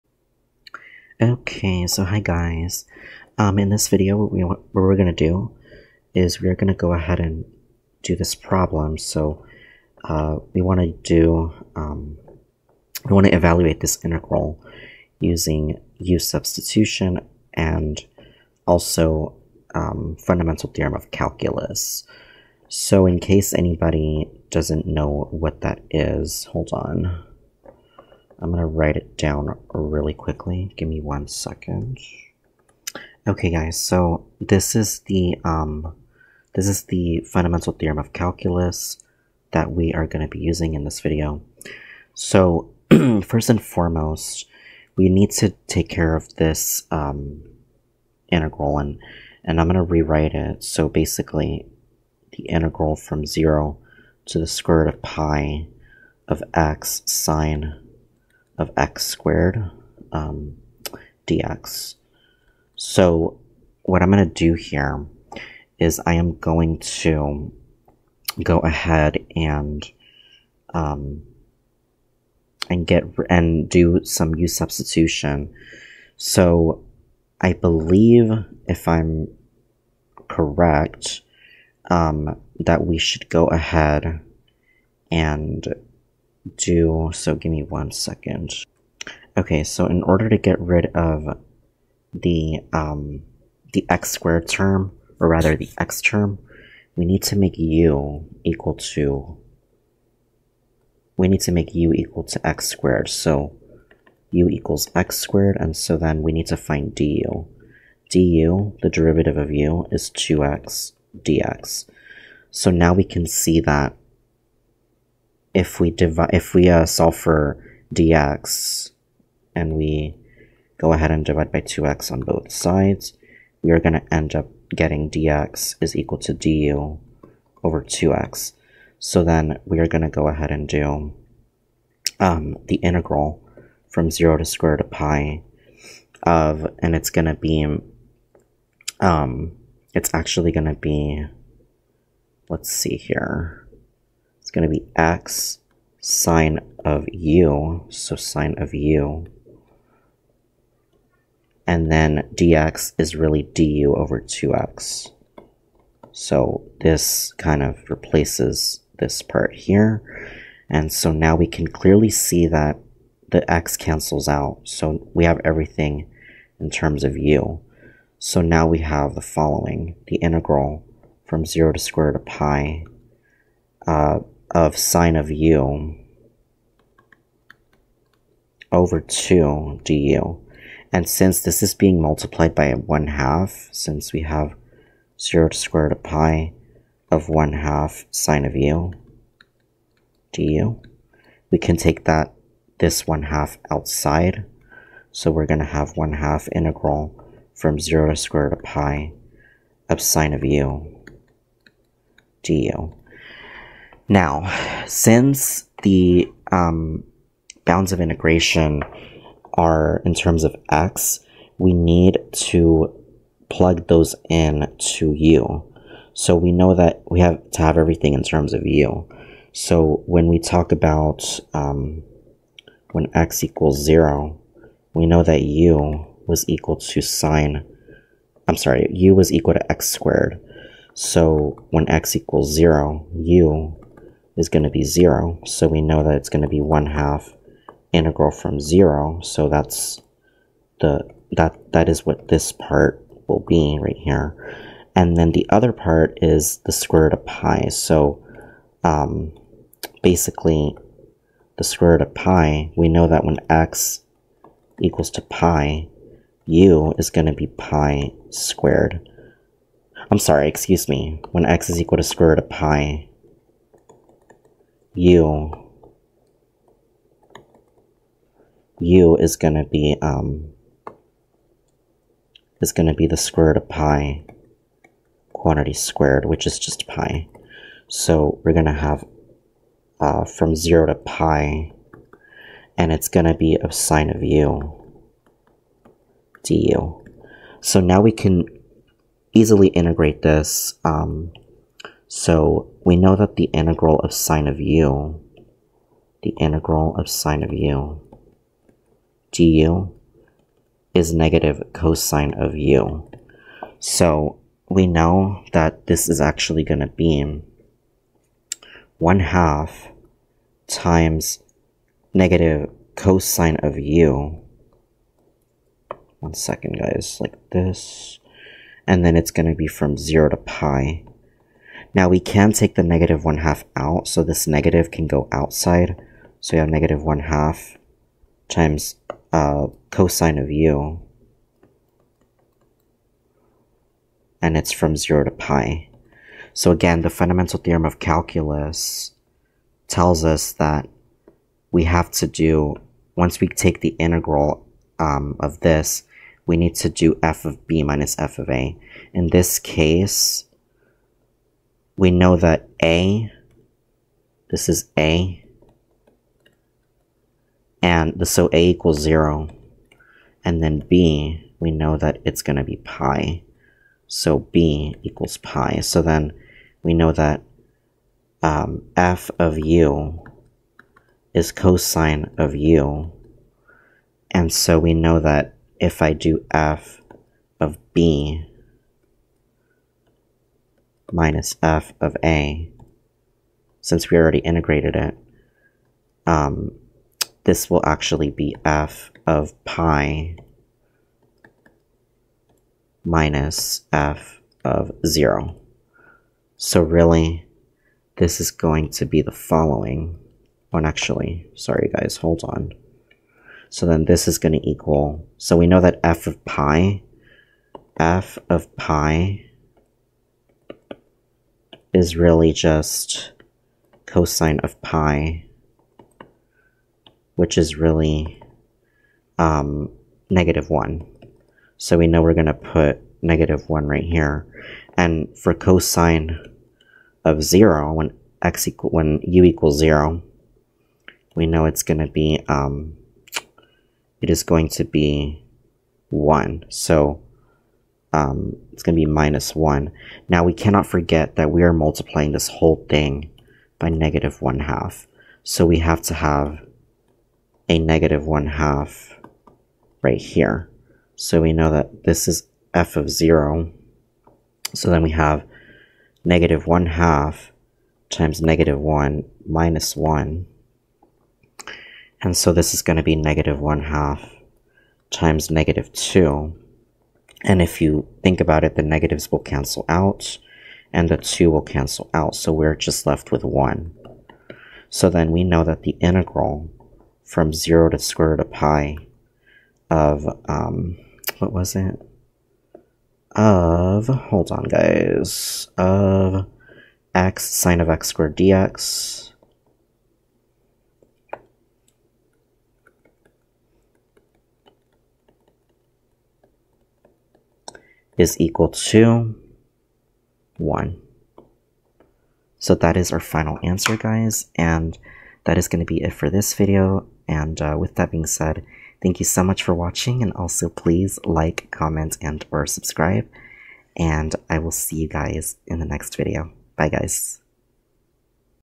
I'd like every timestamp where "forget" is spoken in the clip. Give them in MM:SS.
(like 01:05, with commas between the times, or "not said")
07:20.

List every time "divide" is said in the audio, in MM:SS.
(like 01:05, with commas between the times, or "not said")
01:55, 02:01.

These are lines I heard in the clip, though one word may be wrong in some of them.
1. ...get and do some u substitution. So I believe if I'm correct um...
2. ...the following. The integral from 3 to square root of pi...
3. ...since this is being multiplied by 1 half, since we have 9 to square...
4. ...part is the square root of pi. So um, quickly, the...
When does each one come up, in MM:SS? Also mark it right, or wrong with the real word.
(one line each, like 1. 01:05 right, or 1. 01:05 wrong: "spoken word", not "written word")
1. 01:12 right
2. 02:49 wrong: "0", not "3"
3. 03:01 wrong: "0", not "9"
4. 04:05 wrong: "basically", not "quickly".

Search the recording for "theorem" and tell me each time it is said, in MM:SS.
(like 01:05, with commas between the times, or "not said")
00:20, 00:37, 05:37.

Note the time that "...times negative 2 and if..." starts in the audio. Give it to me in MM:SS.
07:45.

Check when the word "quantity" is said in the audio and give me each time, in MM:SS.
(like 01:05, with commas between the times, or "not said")
04:35.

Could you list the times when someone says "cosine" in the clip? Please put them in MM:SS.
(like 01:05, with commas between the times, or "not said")
05:01, 05:12, 05:29, 06:11, 06:54, 07:05.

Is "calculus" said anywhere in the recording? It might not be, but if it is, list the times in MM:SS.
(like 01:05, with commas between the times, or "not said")
00:21, 00:38, 05:37.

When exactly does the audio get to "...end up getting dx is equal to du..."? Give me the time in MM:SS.
02:04.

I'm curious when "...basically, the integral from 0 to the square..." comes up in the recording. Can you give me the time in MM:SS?
00:50.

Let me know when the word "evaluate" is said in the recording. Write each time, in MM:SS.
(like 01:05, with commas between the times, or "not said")
00:13.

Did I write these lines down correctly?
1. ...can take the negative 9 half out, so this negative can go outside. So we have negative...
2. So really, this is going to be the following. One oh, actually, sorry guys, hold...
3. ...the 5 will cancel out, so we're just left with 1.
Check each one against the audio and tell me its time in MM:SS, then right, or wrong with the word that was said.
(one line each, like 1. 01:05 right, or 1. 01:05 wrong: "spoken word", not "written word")
1. 05:22 wrong: "1", not "9"
2. 06:36 right
3. 07:51 wrong: "2", not "5".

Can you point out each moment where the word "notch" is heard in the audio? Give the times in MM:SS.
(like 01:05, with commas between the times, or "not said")
not said.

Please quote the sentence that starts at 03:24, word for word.
Now, since the um, bounds of integration are in terms of x, we need to plug those in to u.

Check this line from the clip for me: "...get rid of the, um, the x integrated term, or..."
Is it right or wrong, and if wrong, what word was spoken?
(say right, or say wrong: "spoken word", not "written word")
wrong: "squared", not "integrated".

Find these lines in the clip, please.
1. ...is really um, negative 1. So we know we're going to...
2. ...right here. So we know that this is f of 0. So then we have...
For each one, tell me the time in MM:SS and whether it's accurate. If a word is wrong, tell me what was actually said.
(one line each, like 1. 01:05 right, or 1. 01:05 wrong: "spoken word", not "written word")
1. 06:57 right
2. 07:30 right.